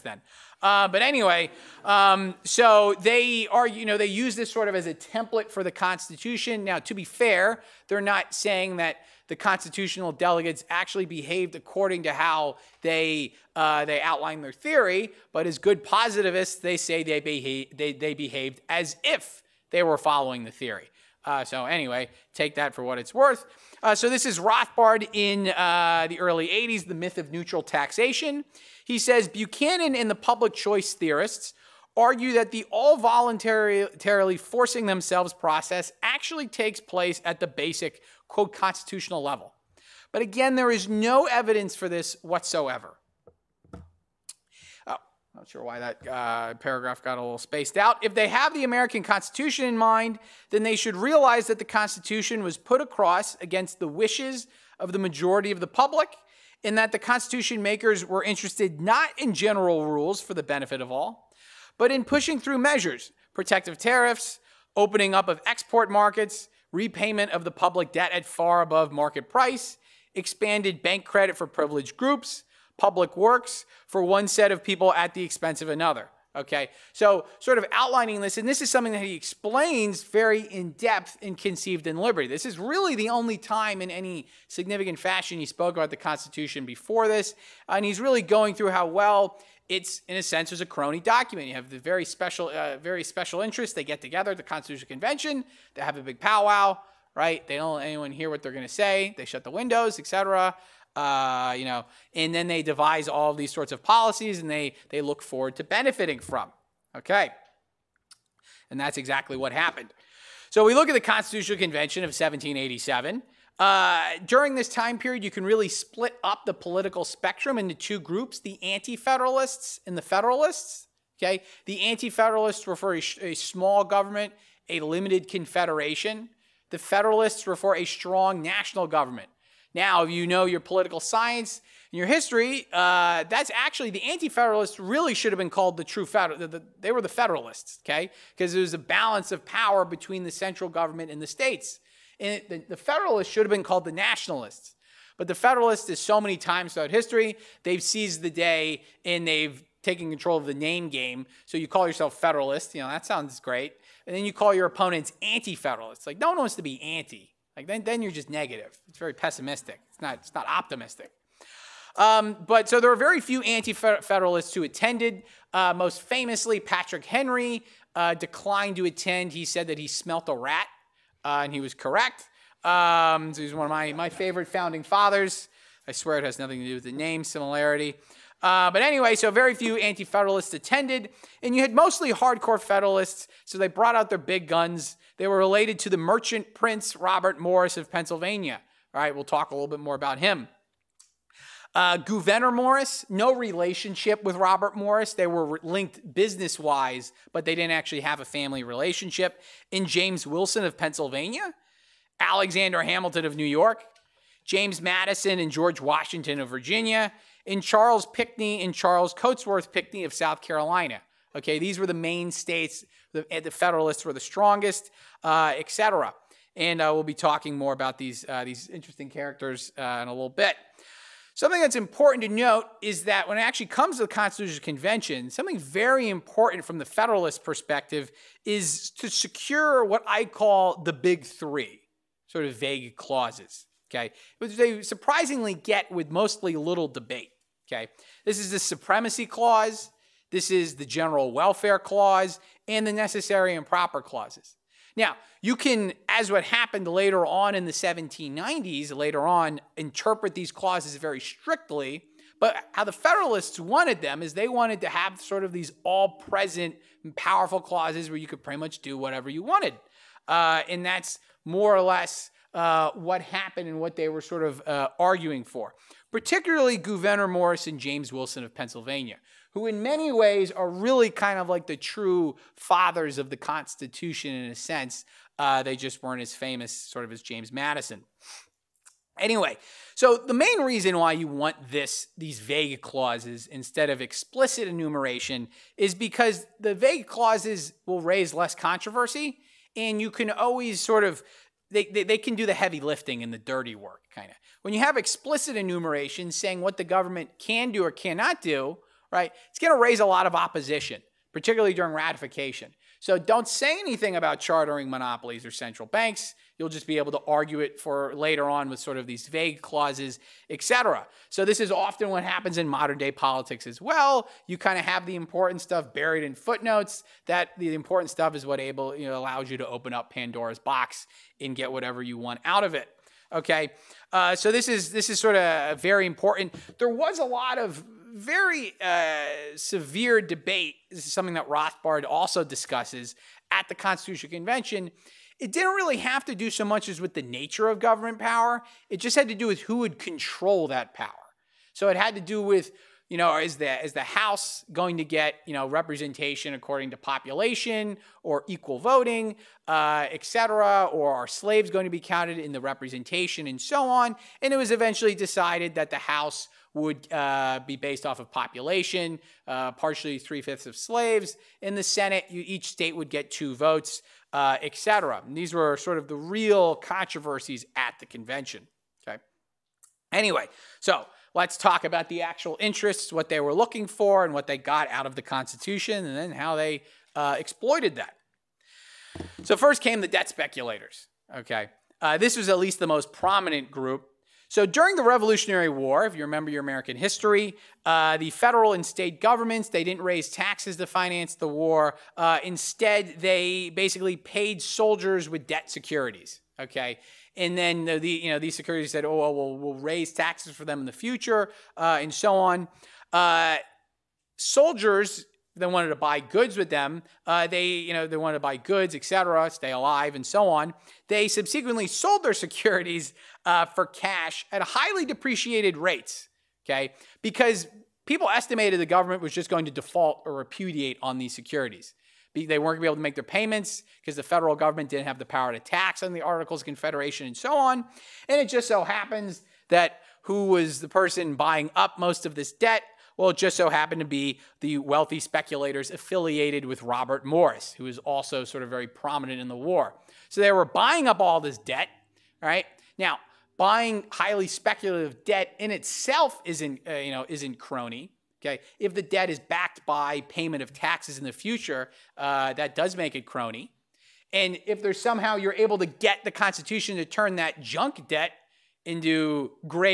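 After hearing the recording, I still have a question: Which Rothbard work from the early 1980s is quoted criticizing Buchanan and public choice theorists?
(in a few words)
The Myth of Neutral Taxation.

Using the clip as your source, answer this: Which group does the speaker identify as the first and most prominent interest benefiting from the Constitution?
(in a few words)
debt speculators.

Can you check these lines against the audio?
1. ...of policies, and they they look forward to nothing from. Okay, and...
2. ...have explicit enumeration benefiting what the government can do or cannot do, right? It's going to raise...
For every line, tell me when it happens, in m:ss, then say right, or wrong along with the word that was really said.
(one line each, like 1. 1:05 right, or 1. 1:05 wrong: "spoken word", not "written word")
1. 1:43 wrong: "benefiting", not "nothing"
2. 4:54 wrong: "saying", not "benefiting".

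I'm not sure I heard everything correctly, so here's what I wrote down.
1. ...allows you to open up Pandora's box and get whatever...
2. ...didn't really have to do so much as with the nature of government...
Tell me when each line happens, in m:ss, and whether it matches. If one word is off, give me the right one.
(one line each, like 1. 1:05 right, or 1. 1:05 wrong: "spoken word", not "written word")
1. 5:19 right
2. 5:35 right.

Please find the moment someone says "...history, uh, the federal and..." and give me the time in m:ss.
6:26.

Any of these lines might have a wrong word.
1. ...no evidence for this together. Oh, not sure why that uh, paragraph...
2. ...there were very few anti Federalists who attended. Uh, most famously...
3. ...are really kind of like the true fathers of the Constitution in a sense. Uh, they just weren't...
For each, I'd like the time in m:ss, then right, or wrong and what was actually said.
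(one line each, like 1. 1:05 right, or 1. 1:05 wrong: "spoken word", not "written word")
1. 0:40 wrong: "whatsoever", not "together"
2. 2:42 right
3. 4:30 right.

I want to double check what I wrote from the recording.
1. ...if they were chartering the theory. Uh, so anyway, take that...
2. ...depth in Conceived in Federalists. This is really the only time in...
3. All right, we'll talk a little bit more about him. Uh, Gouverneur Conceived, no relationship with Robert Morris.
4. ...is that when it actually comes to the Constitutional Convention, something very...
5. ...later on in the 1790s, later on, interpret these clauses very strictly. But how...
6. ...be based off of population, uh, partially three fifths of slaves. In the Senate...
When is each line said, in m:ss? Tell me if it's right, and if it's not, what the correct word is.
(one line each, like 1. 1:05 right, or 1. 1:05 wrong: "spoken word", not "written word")
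1. 0:19 wrong: "following", not "chartering"
2. 1:20 wrong: "Liberty", not "Federalists"
3. 3:08 wrong: "Morris", not "Conceived"
4. 3:42 right
5. 4:06 right
6. 5:57 right.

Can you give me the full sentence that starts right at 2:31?
So you call yourself Federalist, you know, that sounds great.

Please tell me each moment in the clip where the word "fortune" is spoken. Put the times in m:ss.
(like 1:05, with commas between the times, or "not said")
not said.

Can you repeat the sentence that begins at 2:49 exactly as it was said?
He said that he smelt a rat uh, and he was correct.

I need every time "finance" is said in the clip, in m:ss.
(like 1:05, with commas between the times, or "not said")
6:30.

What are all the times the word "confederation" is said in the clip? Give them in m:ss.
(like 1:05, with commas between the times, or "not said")
2:05, 7:06.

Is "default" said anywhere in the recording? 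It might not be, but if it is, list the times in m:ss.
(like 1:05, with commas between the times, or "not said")
6:59.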